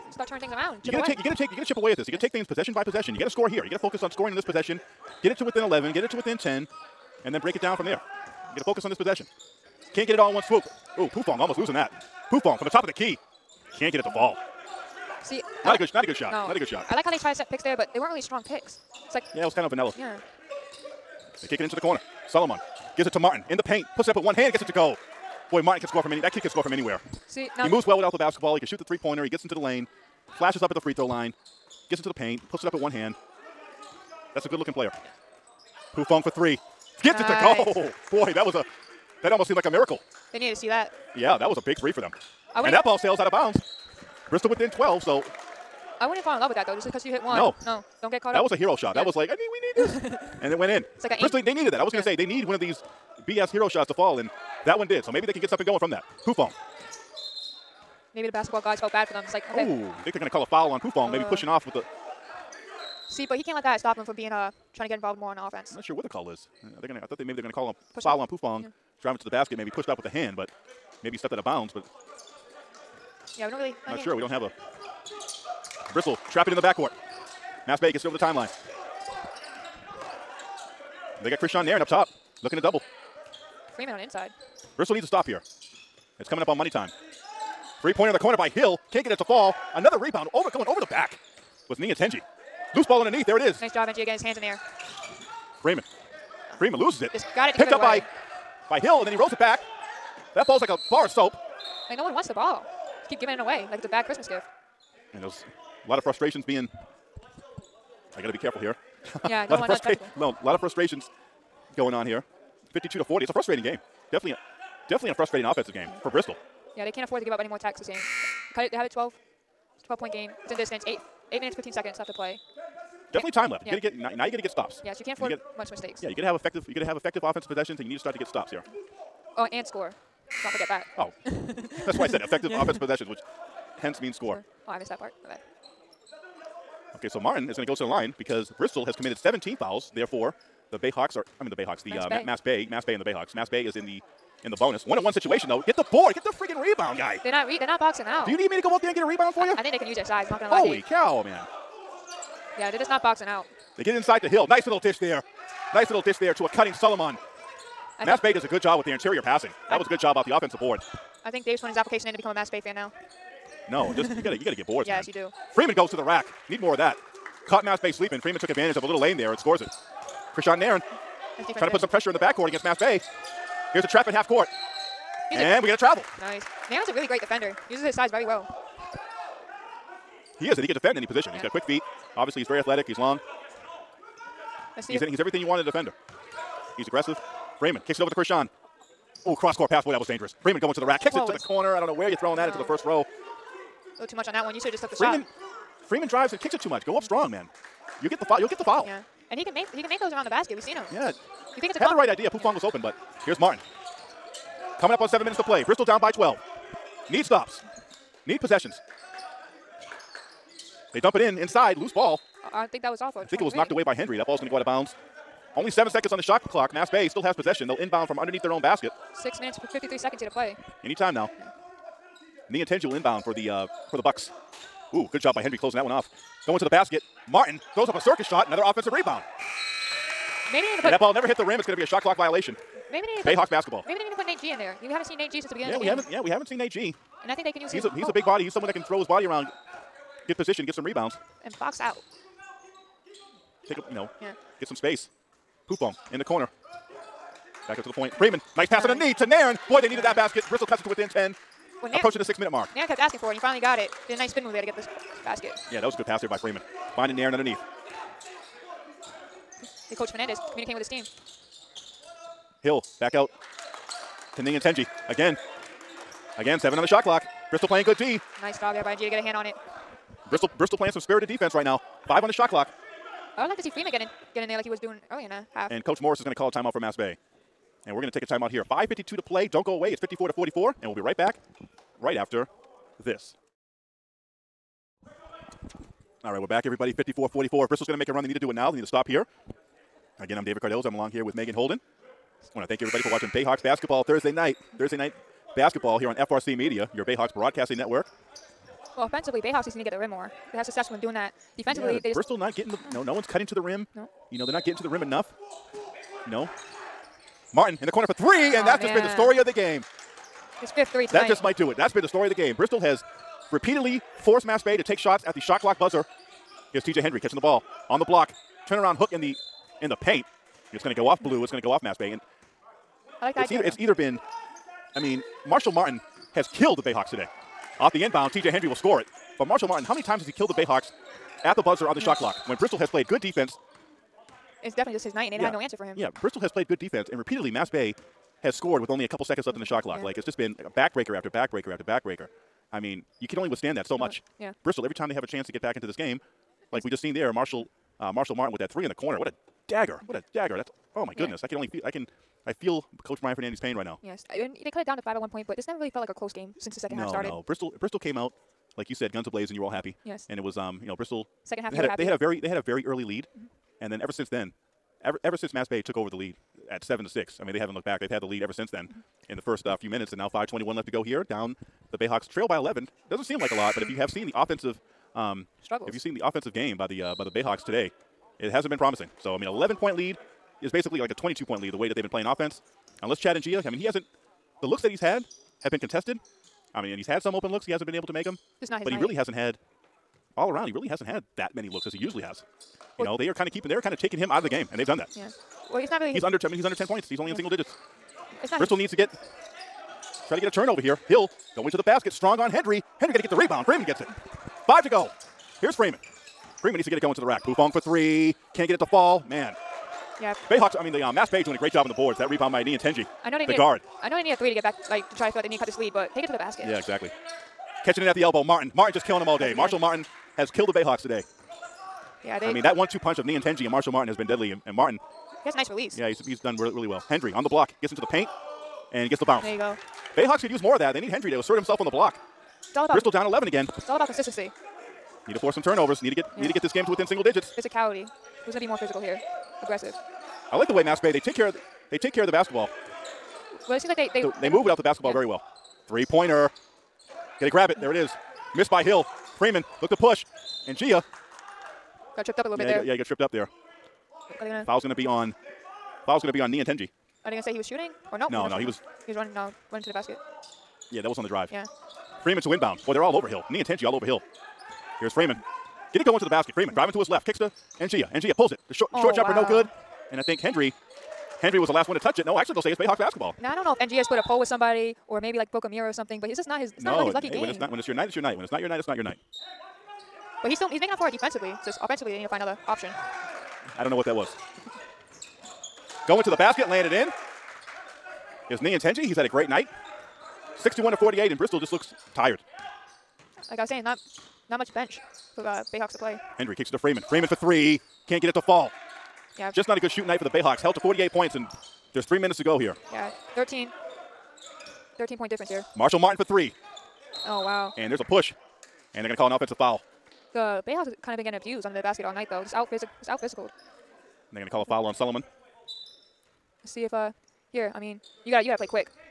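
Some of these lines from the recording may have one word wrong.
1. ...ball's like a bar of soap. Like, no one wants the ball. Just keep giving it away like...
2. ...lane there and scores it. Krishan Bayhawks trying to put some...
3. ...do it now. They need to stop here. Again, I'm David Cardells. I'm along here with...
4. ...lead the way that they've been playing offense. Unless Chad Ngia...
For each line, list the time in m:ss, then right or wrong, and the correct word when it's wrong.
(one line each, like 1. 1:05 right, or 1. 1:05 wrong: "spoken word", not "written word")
1. 1:40 right
2. 2:48 wrong: "Nairn", not "Bayhawks"
3. 4:48 right
4. 6:21 right.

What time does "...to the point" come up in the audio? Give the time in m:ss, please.
4:07.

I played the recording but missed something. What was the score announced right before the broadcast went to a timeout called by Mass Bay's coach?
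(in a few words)
54 to 44.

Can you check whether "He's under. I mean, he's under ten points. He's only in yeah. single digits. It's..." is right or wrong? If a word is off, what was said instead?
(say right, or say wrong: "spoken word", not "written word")
right.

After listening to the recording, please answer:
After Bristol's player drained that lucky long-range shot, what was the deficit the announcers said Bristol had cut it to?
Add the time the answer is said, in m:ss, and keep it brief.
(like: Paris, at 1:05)
12, at 0:44.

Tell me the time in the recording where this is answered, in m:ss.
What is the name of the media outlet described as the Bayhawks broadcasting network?
4:56.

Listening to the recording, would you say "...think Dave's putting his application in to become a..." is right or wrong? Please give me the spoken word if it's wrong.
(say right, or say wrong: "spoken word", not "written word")
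right.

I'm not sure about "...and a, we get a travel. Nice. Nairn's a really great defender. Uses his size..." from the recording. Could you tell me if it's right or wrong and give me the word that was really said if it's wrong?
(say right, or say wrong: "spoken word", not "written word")
right.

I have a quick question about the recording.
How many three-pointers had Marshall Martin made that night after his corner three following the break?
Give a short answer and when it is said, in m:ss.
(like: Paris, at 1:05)
fifth, at 5:10.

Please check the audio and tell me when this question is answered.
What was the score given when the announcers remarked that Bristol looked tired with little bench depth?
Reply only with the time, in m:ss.
8:10.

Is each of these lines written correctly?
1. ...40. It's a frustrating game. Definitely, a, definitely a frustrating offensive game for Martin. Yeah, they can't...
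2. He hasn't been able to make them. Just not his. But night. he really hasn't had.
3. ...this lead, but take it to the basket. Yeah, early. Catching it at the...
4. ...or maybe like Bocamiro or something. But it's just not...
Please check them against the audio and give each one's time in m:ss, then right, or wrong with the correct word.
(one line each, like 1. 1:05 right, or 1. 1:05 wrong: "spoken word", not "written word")
1. 1:53 wrong: "Bristol", not "Martin"
2. 6:27 right
3. 6:55 wrong: "exactly", not "early"
4. 7:55 right.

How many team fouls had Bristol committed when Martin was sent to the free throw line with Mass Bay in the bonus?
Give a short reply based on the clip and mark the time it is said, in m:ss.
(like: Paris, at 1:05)
17, at 2:19.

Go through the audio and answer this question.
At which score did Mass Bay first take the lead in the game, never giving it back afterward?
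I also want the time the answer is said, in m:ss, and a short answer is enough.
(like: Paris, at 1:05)
7 to 6, at 6:06.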